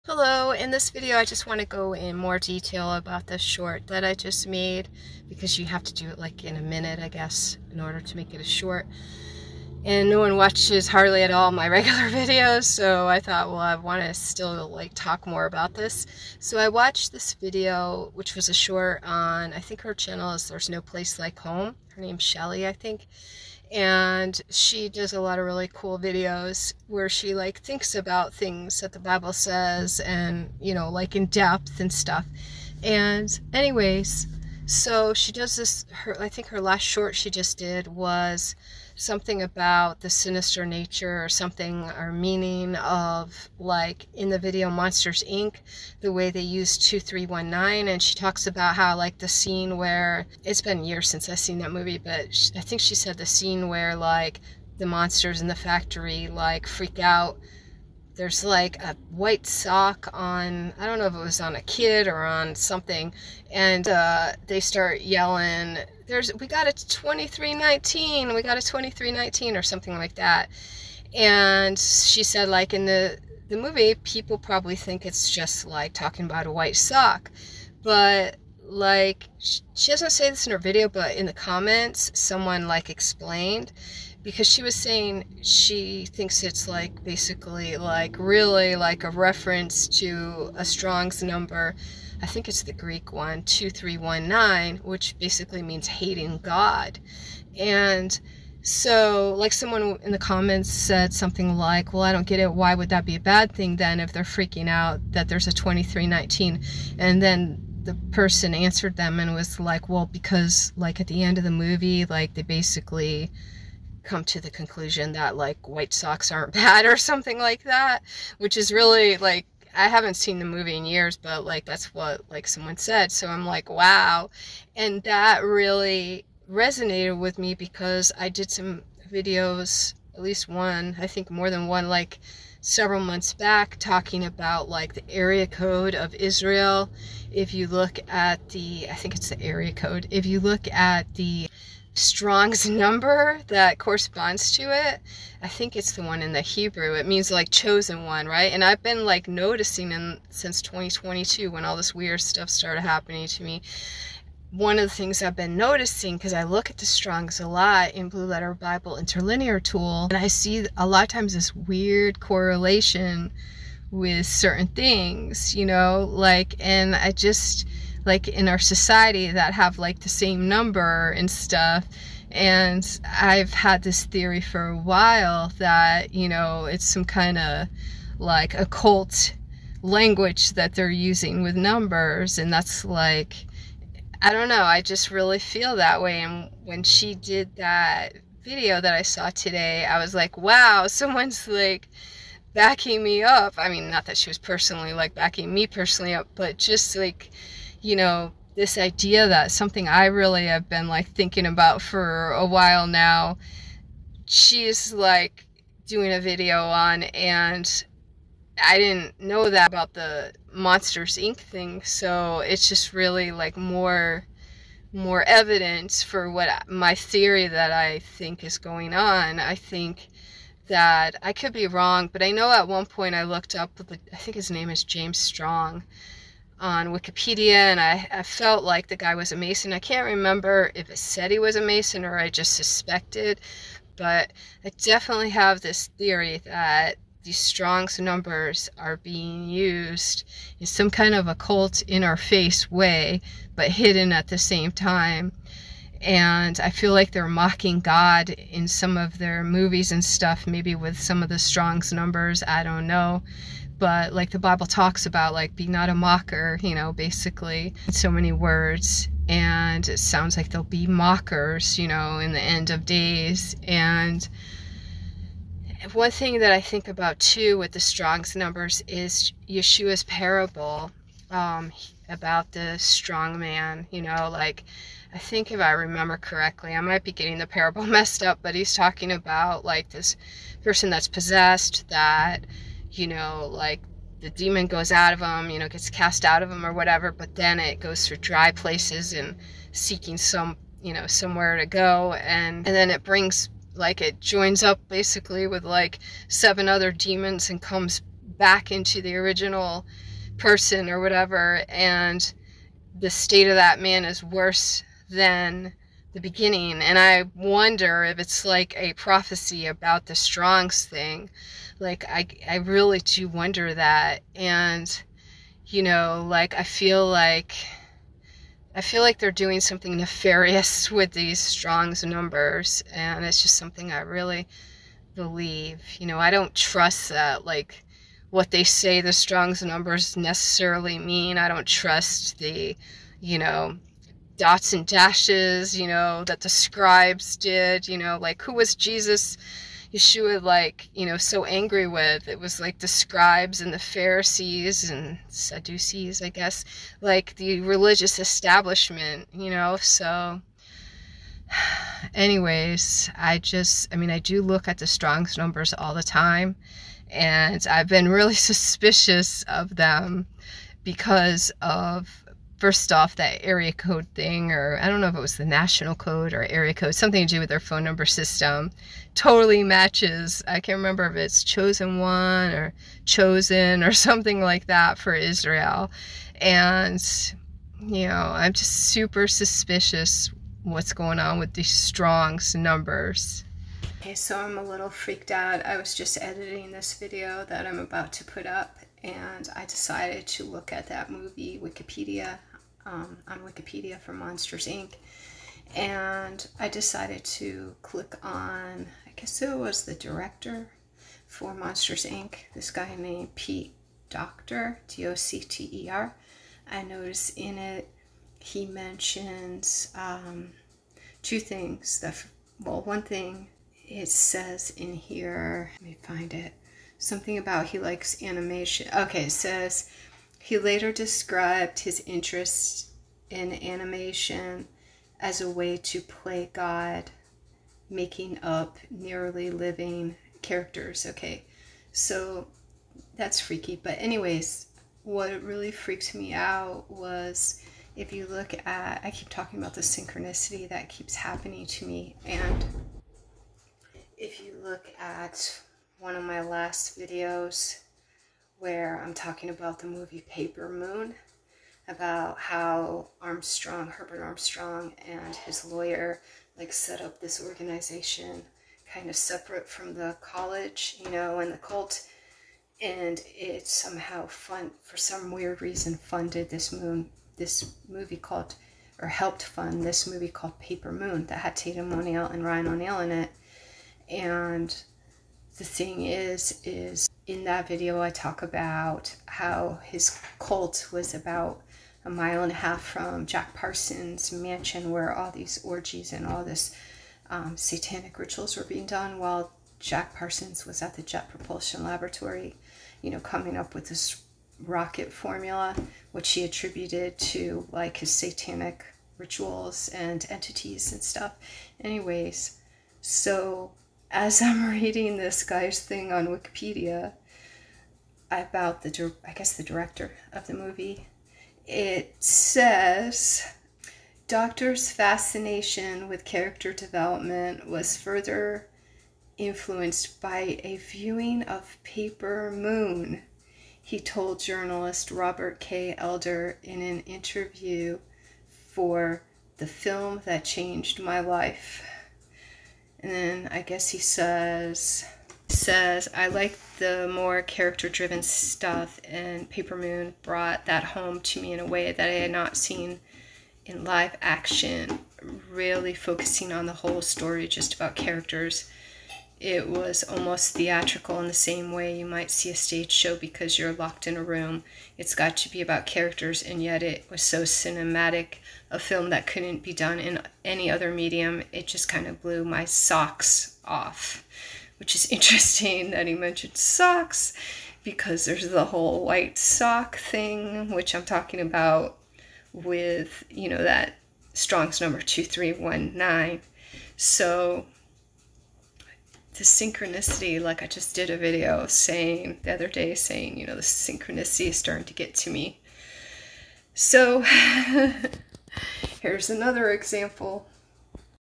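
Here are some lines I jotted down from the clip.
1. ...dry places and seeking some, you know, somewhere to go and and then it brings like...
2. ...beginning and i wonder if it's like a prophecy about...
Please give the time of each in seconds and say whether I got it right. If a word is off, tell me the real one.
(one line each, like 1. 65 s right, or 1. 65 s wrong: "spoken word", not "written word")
1. 288 s right
2. 306 s right.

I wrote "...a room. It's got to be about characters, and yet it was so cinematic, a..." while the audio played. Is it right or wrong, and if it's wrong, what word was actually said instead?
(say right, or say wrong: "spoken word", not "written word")
right.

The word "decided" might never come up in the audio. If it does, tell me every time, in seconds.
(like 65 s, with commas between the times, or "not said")
389 s, 396 s.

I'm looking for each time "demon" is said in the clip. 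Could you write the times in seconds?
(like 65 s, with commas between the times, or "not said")
284 s, 296 s.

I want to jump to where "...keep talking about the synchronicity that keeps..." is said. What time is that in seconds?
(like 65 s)
439 s.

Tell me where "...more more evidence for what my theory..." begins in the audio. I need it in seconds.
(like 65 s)
213 s.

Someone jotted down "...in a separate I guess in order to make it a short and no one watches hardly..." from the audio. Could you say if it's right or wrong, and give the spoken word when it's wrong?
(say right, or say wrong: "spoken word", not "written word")
wrong: "minute", not "separate".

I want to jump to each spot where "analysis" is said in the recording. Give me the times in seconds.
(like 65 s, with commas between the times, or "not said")
not said.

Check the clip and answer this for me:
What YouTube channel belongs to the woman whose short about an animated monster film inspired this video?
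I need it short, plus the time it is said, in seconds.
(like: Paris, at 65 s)
There's No Place Like Home, at 20 s.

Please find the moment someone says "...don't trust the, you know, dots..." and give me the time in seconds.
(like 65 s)
331 s.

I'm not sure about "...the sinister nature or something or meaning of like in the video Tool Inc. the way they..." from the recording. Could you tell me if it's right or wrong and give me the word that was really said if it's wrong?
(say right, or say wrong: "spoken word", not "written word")
wrong: "Monsters", not "Tool".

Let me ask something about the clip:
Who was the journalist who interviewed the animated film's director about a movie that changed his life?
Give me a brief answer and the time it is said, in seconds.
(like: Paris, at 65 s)
Robert K. Elder, at 525 s.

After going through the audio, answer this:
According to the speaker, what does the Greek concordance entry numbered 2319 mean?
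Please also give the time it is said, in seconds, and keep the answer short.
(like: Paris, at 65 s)
hating God, at 95 s.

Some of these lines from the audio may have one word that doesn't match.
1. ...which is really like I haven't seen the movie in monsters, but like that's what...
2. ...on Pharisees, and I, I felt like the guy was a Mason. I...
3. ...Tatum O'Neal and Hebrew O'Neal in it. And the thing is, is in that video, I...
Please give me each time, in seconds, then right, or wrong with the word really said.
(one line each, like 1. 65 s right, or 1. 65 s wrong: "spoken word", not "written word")
1. 118 s wrong: "years", not "monsters"
2. 226 s wrong: "Wikipedia", not "Pharisees"
3. 471 s wrong: "Ryan", not "Hebrew".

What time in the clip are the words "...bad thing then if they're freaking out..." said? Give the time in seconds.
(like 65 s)
103 s.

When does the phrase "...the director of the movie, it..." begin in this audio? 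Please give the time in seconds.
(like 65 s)
509 s.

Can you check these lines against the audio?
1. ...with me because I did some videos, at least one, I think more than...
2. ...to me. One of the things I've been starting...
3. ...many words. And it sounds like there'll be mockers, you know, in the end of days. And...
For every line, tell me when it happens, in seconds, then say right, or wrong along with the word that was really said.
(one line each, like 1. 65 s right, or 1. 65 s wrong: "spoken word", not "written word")
1. 127 s right
2. 153 s wrong: "noticing", not "starting"
3. 258 s right.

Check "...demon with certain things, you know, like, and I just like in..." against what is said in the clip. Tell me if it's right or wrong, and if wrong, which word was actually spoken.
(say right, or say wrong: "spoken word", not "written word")
wrong: "correlation", not "demon".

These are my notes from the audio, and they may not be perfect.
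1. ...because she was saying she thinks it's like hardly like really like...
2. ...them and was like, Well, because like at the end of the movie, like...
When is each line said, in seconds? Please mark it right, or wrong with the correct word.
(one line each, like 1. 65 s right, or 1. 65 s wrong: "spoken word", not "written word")
1. 84 s wrong: "basically", not "hardly"
2. 108 s right.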